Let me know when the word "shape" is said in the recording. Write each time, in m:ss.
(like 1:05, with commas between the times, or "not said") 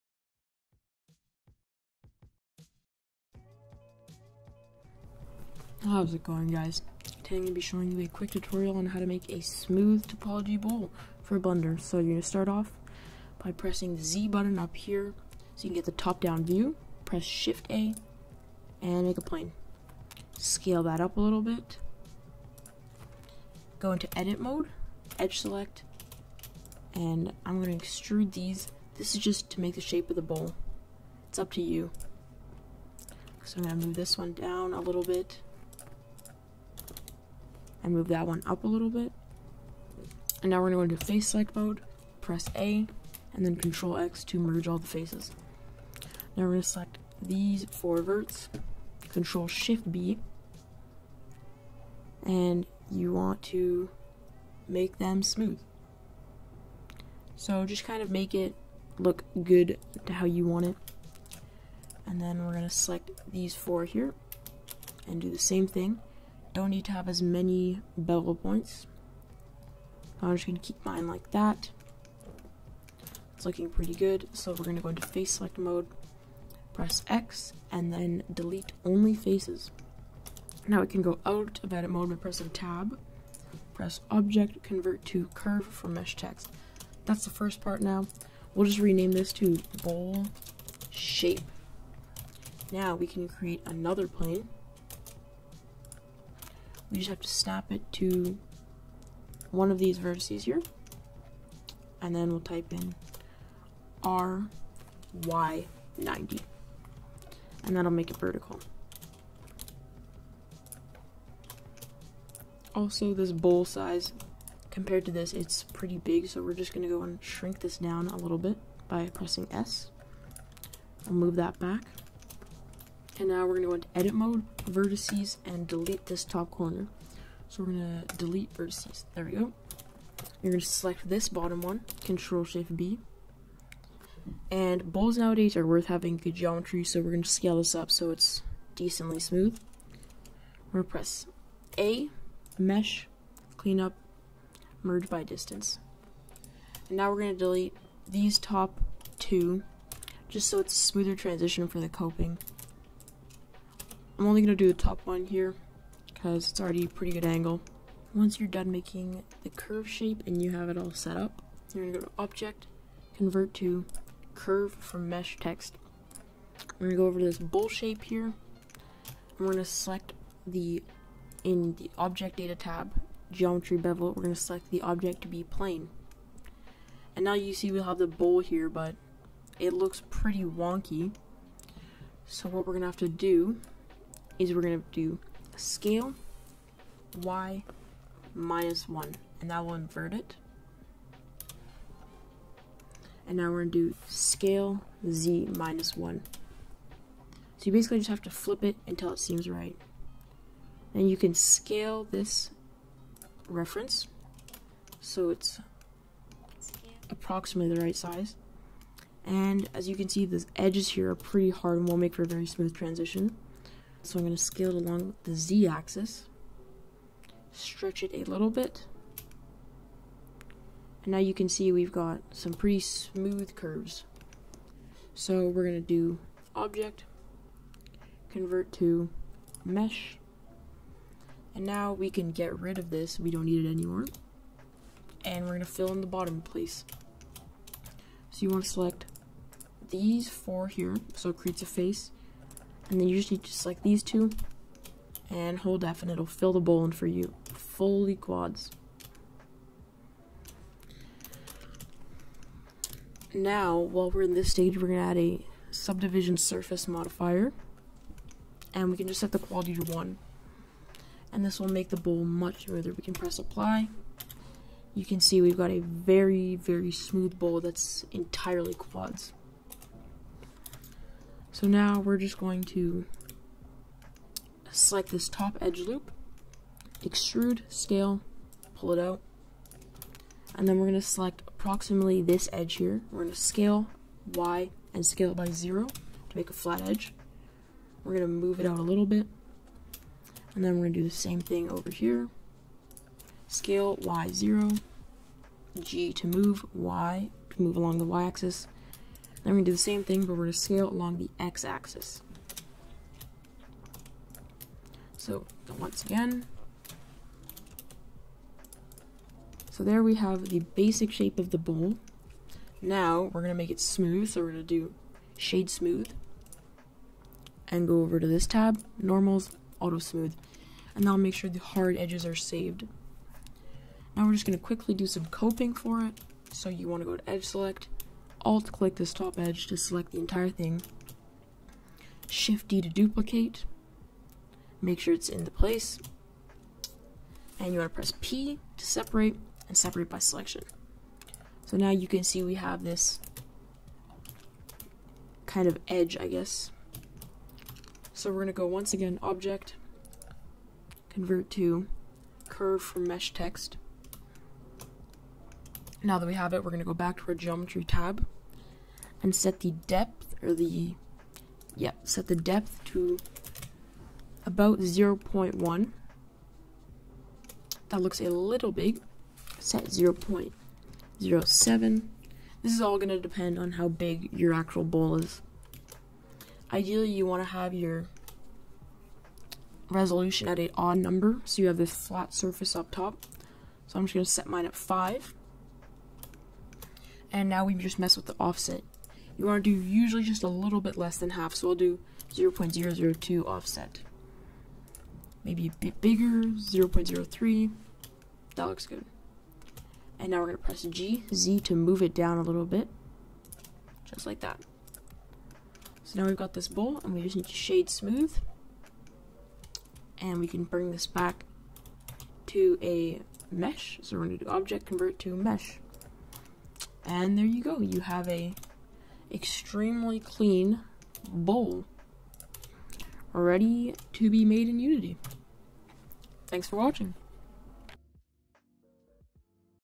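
0:29, 1:30, 2:39, 2:47, 5:11.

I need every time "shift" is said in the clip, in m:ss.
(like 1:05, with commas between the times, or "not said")
0:17, 0:49, 2:12, 5:32.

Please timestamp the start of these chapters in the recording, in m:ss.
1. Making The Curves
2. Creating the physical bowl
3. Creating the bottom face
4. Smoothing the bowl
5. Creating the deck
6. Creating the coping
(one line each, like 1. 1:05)
1. 1:26
2. 2:50
3. 3:59
4. 4:13
5. 4:36
6. 5:09.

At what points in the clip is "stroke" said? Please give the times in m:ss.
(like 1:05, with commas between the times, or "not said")
not said.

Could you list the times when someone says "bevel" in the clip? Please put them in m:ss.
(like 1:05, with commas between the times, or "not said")
1:07, 2:53.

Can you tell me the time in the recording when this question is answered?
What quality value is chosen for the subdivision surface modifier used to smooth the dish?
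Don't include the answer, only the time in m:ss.
4:19.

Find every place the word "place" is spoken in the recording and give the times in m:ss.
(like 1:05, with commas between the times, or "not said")
3:56, 5:35.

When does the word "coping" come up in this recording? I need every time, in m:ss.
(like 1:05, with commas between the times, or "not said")
2:31, 5:25.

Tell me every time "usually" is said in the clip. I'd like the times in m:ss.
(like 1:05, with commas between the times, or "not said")
4:03, 6:29.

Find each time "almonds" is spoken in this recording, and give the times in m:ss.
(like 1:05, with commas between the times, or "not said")
not said.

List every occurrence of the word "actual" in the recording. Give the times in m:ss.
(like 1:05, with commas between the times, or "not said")
6:14.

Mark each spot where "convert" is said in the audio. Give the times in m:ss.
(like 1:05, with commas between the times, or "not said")
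1:24, 2:43, 3:48, 5:51, 6:54.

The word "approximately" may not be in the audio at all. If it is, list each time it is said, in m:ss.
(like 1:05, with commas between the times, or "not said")
3:27, 4:41.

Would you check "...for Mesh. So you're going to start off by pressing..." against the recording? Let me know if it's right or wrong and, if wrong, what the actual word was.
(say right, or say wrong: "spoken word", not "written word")
wrong: "Blender", not "Mesh".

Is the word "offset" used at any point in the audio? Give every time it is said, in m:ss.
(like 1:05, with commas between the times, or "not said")
6:28, 6:33.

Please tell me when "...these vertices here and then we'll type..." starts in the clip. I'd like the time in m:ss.
1:39.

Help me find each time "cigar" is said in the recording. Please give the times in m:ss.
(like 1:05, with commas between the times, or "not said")
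not said.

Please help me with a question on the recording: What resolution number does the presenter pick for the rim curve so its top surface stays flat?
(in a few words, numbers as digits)
5.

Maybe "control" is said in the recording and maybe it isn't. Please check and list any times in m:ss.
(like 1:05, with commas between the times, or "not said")
0:43, 0:49, 2:12.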